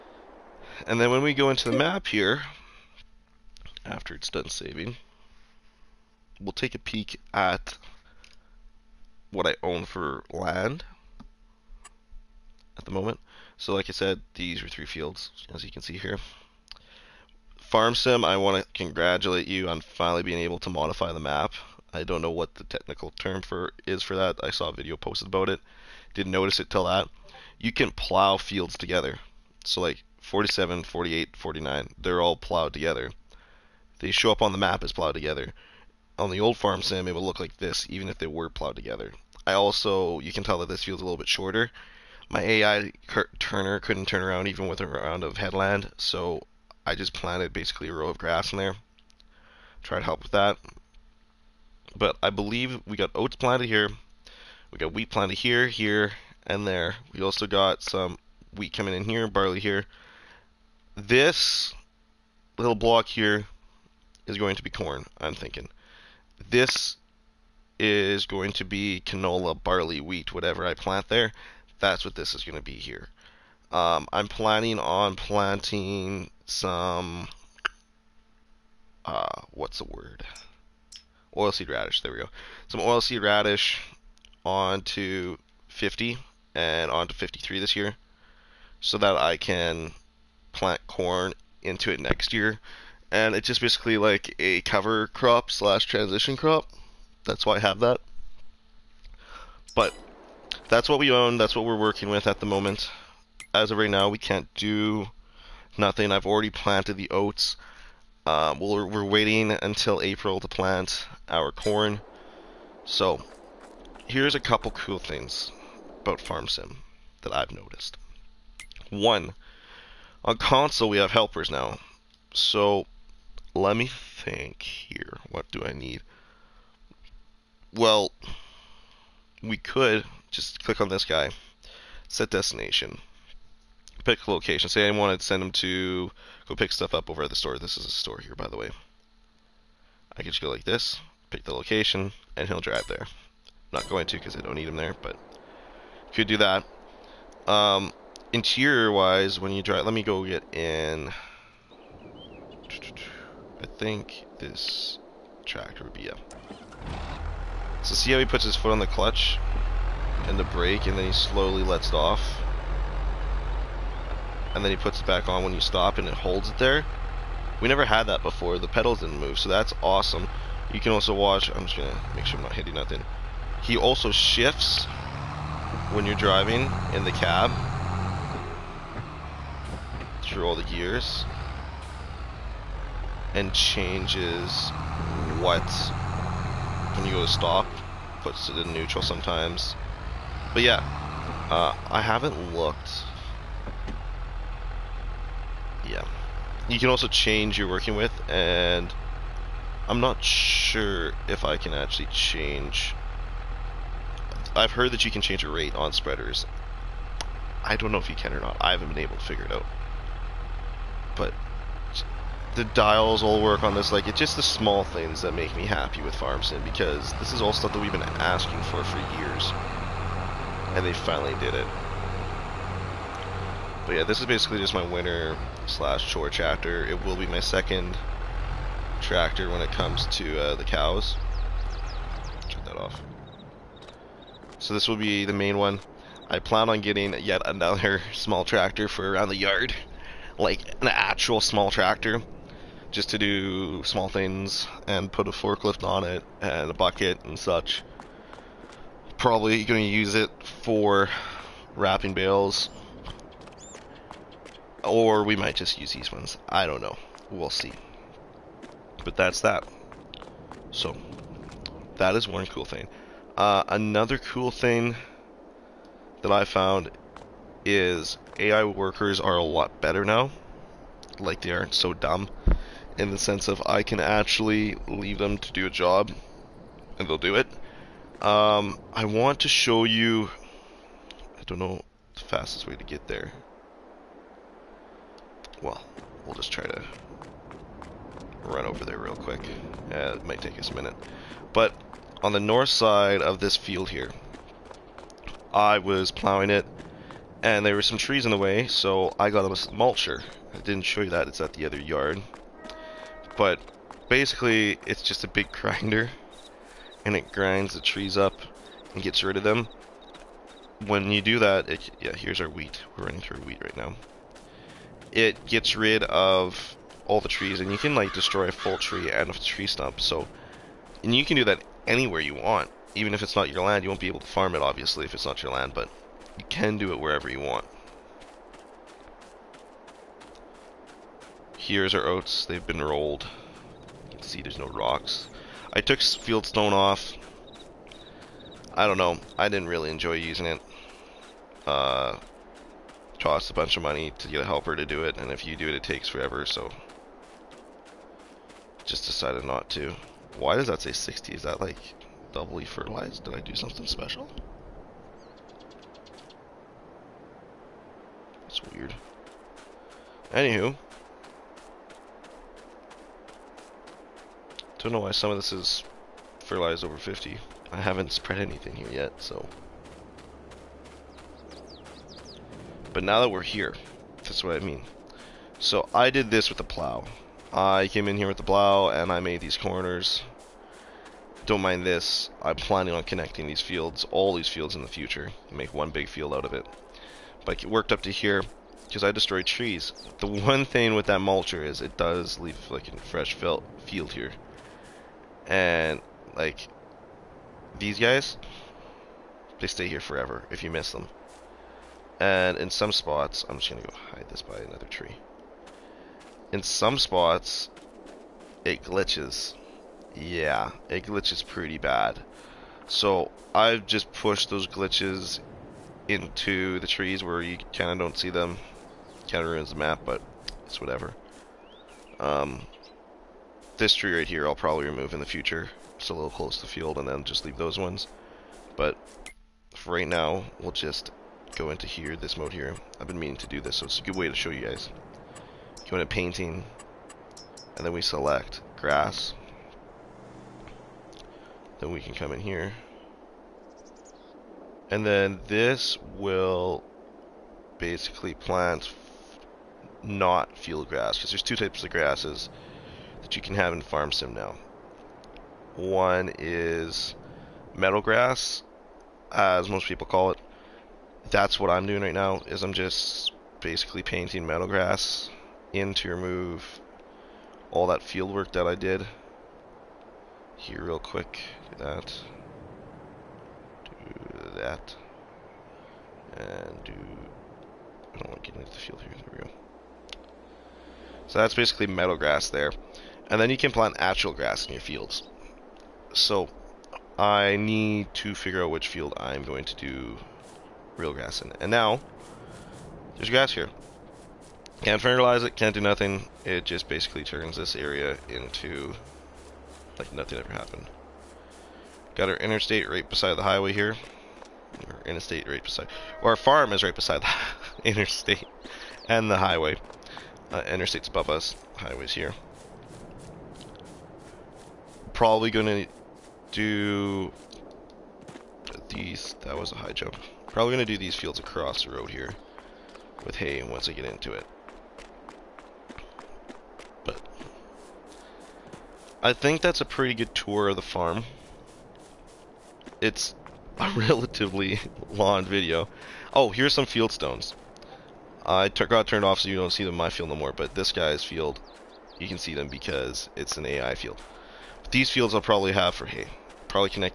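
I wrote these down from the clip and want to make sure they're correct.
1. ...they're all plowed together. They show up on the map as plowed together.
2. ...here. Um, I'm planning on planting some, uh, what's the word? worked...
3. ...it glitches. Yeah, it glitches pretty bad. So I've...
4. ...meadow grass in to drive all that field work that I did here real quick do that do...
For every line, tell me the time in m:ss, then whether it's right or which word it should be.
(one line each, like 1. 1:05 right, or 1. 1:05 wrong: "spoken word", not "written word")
1. 0:31 right
2. 1:12 wrong: "oilseed", not "worked"
3. 6:48 right
4. 7:44 wrong: "remove", not "drive".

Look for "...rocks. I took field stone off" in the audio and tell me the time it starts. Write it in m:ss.
5:34.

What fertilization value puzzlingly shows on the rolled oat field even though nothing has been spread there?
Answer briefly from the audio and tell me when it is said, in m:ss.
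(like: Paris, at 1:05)
60, at 5:50.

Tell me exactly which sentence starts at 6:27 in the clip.
But it worked up to here because I destroyed trees.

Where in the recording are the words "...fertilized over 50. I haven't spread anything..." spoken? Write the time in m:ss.
6:06.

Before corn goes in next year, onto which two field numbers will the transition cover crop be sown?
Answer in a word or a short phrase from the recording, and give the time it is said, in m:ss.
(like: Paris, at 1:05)
50 and 53, at 1:24.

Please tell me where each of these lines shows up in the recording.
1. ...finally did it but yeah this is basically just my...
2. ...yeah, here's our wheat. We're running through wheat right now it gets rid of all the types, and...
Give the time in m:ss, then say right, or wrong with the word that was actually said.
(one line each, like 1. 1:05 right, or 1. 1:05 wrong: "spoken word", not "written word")
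1. 3:40 right
2. 5:11 wrong: "trees", not "types".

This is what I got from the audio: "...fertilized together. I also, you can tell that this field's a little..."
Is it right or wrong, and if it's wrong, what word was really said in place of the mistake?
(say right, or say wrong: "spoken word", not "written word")
wrong: "plowed", not "fertilized".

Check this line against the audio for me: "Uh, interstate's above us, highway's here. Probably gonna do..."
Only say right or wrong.
right.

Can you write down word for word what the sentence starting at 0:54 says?
We got wheat planted here, here, and there.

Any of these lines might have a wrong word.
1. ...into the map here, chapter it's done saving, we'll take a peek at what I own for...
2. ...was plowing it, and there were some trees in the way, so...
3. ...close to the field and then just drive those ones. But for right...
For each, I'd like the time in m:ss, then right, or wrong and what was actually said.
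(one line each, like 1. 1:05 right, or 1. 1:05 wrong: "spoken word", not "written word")
1. 0:01 wrong: "after", not "chapter"
2. 4:55 right
3. 7:06 wrong: "leave", not "drive".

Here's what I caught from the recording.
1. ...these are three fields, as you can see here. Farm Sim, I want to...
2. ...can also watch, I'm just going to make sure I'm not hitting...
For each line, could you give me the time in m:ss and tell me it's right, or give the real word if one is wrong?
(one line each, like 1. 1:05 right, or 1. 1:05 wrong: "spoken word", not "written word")
1. 0:14 right
2. 2:50 right.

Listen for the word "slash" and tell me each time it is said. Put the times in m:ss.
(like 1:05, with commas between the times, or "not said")
1:35, 3:45.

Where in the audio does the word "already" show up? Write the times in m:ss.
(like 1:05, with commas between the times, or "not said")
1:46.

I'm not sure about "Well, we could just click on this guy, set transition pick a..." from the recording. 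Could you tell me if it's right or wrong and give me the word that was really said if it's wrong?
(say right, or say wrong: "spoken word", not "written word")
wrong: "destination", not "transition".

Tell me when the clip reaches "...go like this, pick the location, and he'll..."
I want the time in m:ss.
2:20.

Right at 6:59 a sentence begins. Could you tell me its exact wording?
Kind of ruins the map, but it's whatever.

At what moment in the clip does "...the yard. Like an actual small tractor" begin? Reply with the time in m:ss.
3:59.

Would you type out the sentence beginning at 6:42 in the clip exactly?
And in some spots, I'm just going to go hide this by another tree.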